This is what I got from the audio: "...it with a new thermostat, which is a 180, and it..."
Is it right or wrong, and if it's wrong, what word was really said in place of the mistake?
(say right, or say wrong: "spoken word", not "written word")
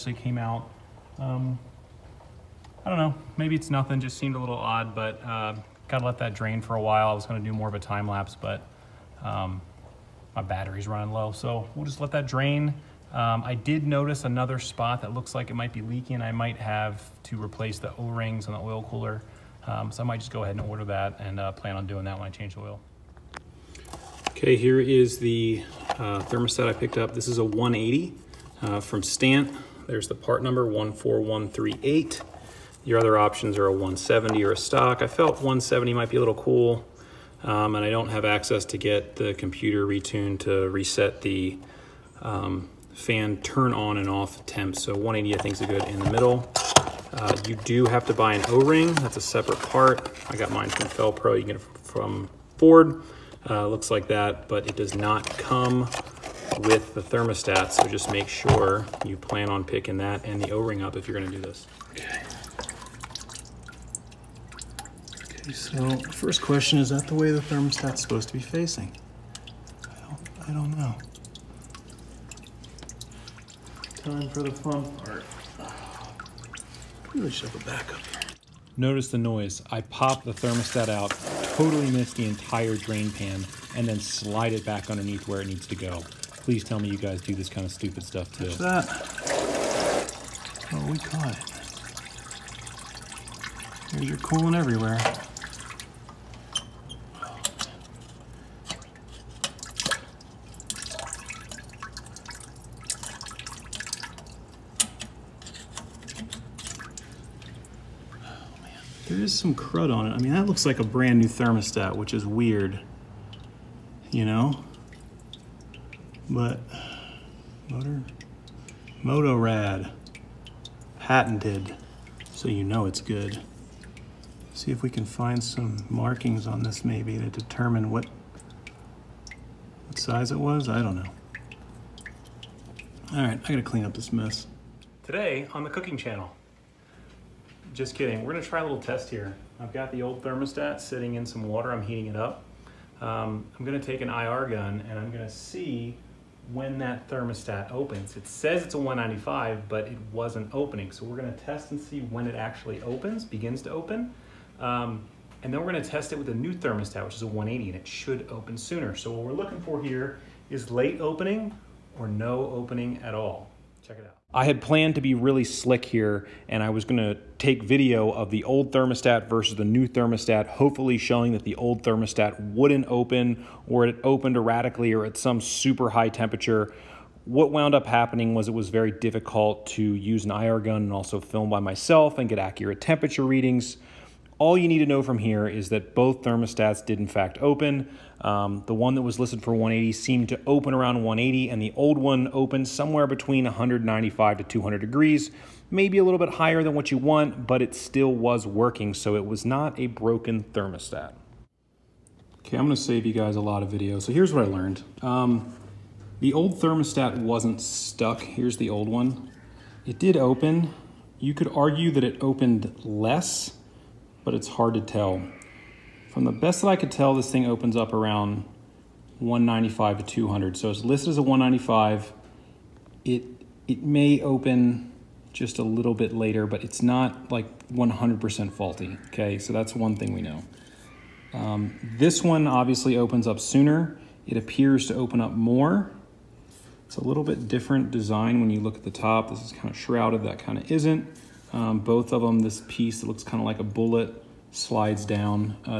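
right.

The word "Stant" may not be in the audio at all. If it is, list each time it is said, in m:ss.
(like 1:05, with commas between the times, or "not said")
0:29.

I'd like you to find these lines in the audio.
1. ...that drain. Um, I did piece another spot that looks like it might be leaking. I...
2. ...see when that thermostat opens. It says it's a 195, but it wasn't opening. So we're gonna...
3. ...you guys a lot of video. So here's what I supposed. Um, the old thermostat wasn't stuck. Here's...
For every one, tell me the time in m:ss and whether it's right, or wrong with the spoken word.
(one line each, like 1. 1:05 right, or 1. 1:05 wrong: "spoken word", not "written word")
1. 0:12 wrong: "notice", not "piece"
2. 2:25 right
3. 3:23 wrong: "learned", not "supposed".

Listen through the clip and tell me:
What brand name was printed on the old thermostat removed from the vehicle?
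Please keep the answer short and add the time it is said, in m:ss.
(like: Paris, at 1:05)
Motorad, at 1:59.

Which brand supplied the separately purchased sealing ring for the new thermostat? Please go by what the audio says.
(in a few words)
Fel-Pro.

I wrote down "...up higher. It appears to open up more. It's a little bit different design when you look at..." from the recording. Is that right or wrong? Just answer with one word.
wrong.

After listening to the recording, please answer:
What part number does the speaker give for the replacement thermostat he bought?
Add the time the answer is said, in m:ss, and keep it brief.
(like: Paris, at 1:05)
14138, at 0:30.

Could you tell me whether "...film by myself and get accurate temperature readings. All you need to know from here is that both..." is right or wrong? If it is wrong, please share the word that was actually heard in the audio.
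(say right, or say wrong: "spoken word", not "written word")
right.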